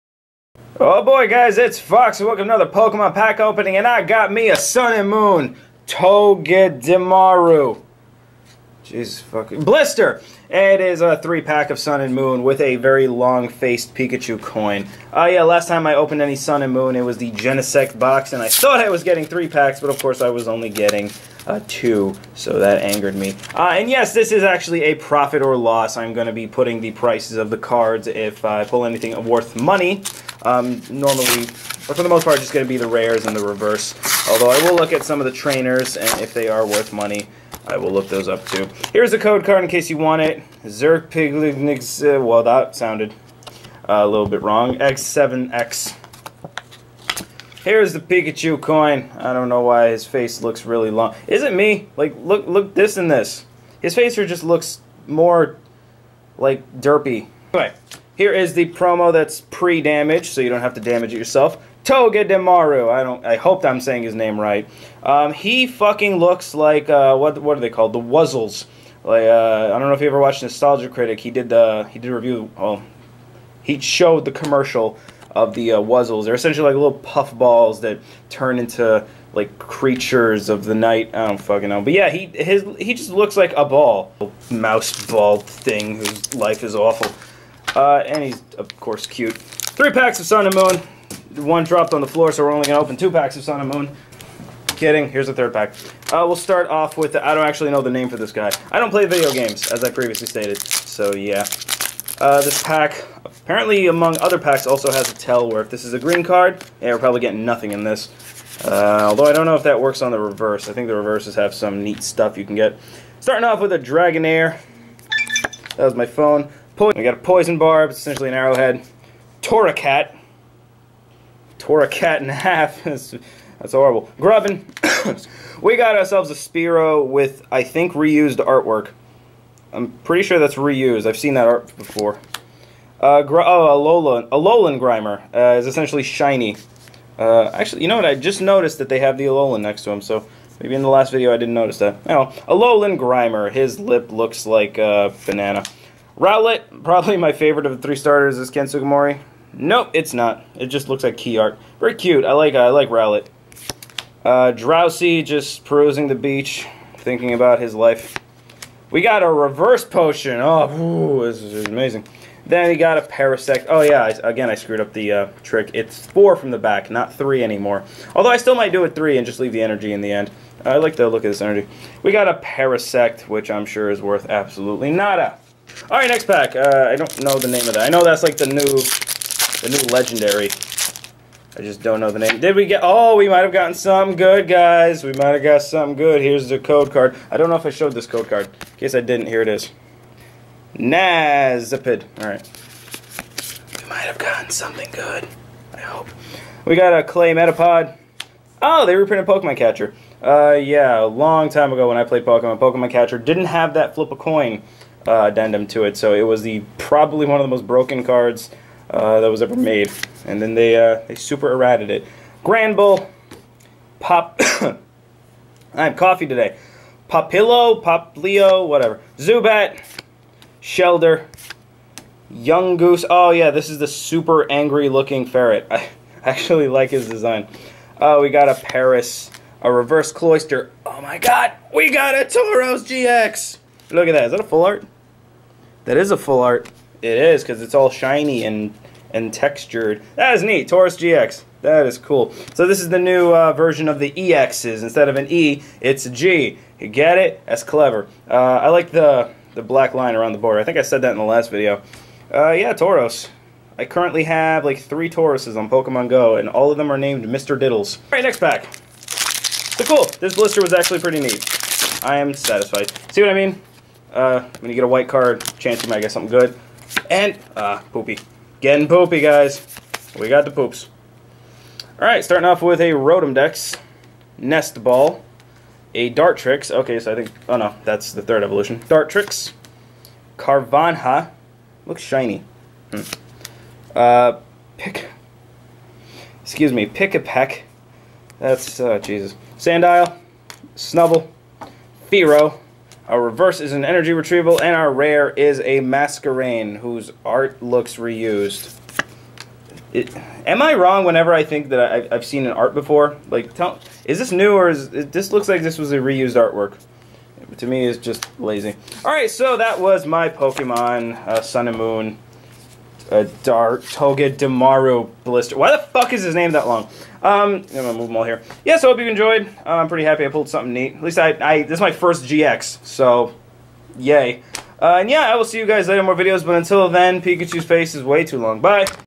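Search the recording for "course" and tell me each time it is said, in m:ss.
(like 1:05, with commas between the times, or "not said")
0:20, 1:28.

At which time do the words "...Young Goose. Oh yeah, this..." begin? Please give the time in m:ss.
3:42.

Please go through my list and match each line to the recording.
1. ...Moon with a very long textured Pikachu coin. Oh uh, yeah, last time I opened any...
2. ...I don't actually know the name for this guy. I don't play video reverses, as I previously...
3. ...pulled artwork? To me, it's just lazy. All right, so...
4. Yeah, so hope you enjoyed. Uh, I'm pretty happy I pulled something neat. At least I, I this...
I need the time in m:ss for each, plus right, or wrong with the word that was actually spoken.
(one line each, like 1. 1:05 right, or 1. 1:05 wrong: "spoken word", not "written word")
1. 0:12 wrong: "faced", not "textured"
2. 1:37 wrong: "games", not "reverses"
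3. 5:05 wrong: "reused", not "pulled"
4. 5:18 right.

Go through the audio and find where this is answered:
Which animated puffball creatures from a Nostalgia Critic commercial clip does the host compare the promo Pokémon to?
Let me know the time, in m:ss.
1:07.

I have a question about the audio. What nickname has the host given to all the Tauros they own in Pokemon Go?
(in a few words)
Mr. Diddles.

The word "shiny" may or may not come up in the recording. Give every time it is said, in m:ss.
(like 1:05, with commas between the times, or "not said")
2:16, 3:57, 4:42.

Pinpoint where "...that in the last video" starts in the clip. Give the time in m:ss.
4:11.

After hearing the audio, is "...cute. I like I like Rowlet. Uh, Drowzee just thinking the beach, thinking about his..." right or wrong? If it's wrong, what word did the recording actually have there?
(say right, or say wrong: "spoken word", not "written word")
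wrong: "perusing", not "thinking".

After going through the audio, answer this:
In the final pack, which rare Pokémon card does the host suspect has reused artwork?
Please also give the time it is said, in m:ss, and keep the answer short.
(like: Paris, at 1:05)
Masquerain, at 4:55.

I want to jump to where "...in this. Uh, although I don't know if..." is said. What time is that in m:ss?
1:47.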